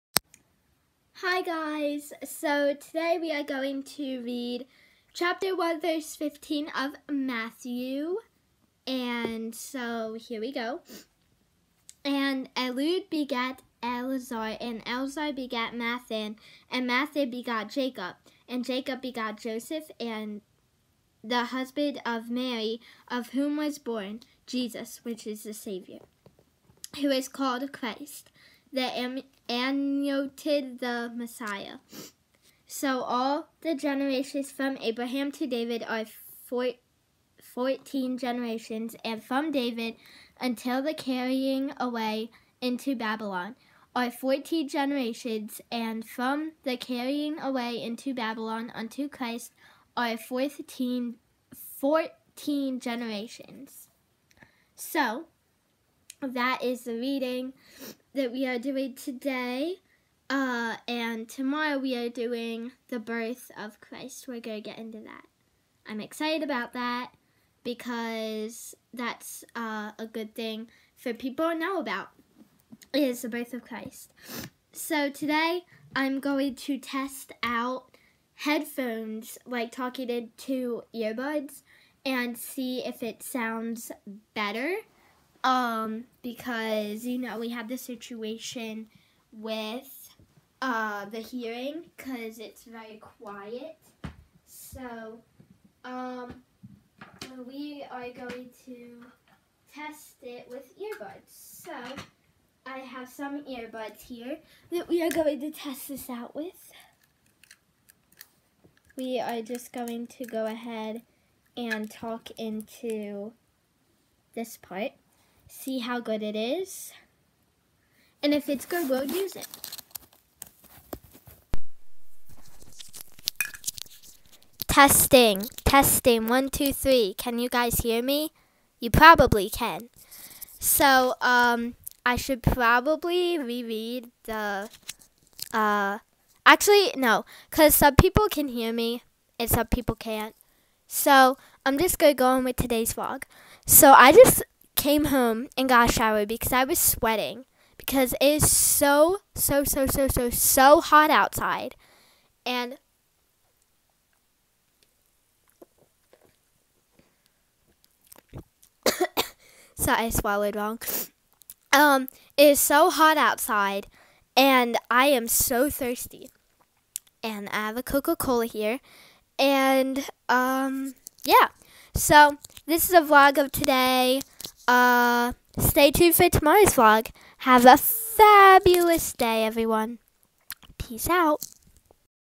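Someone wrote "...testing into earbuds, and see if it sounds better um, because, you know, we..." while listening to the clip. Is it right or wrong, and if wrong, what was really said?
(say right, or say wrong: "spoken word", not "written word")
wrong: "talking", not "testing".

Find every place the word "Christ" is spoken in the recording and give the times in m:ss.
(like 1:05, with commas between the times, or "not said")
0:27, 0:49, 1:03, 1:13.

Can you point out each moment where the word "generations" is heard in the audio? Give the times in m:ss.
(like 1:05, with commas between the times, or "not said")
0:33, 0:38, 0:44, 0:52.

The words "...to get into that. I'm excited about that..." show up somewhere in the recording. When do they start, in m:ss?
1:04.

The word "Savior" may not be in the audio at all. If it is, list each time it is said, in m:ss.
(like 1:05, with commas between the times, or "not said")
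0:25.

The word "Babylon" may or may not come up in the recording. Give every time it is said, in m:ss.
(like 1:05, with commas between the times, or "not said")
0:42, 0:48.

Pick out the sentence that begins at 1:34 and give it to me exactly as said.
So, um, we are going to test it with earbuds.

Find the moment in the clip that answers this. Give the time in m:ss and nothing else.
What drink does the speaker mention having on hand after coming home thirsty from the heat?
2:47.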